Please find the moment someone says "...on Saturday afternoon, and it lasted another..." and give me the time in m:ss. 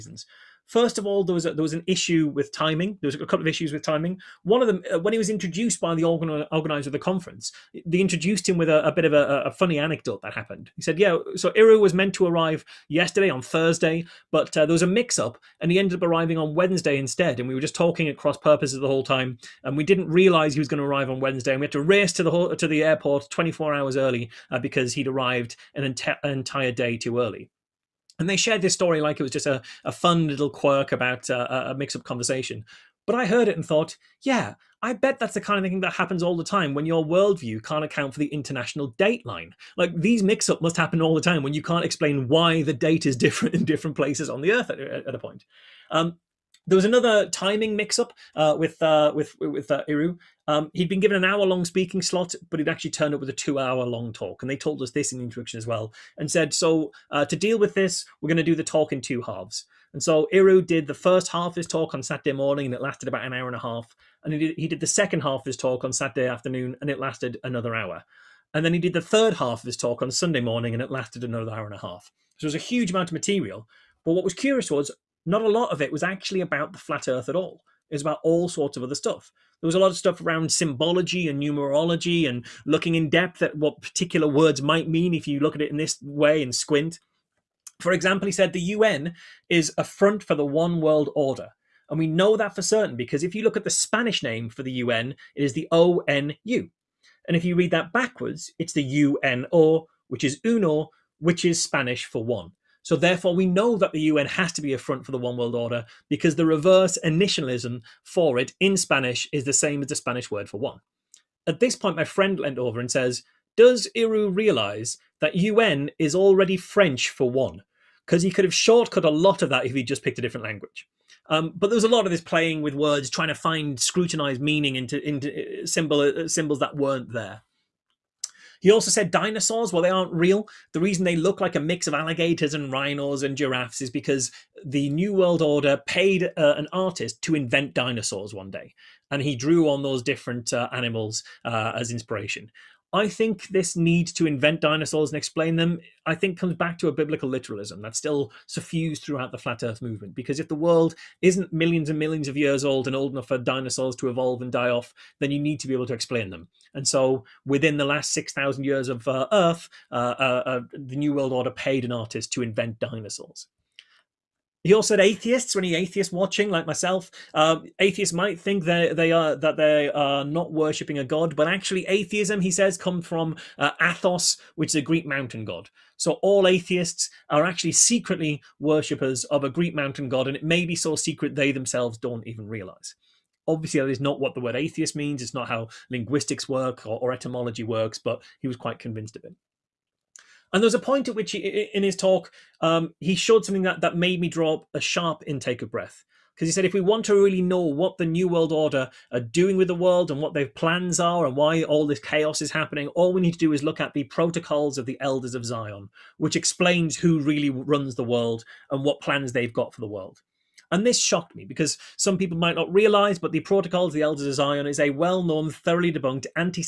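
1:05.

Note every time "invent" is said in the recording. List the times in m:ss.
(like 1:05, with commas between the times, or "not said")
2:17, 2:24, 2:42.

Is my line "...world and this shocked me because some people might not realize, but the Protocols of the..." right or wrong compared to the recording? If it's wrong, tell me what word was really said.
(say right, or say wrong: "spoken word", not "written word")
right.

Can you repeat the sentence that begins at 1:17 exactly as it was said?
It was about all sorts of other stuff.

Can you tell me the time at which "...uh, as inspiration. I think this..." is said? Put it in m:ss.
2:21.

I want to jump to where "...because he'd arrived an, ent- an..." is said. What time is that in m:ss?
0:24.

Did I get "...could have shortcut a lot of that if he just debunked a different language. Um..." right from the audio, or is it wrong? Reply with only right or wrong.
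wrong.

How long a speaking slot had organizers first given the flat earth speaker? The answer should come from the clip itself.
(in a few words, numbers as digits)
an hour.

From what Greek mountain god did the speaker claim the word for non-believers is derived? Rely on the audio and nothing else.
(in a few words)
Athos.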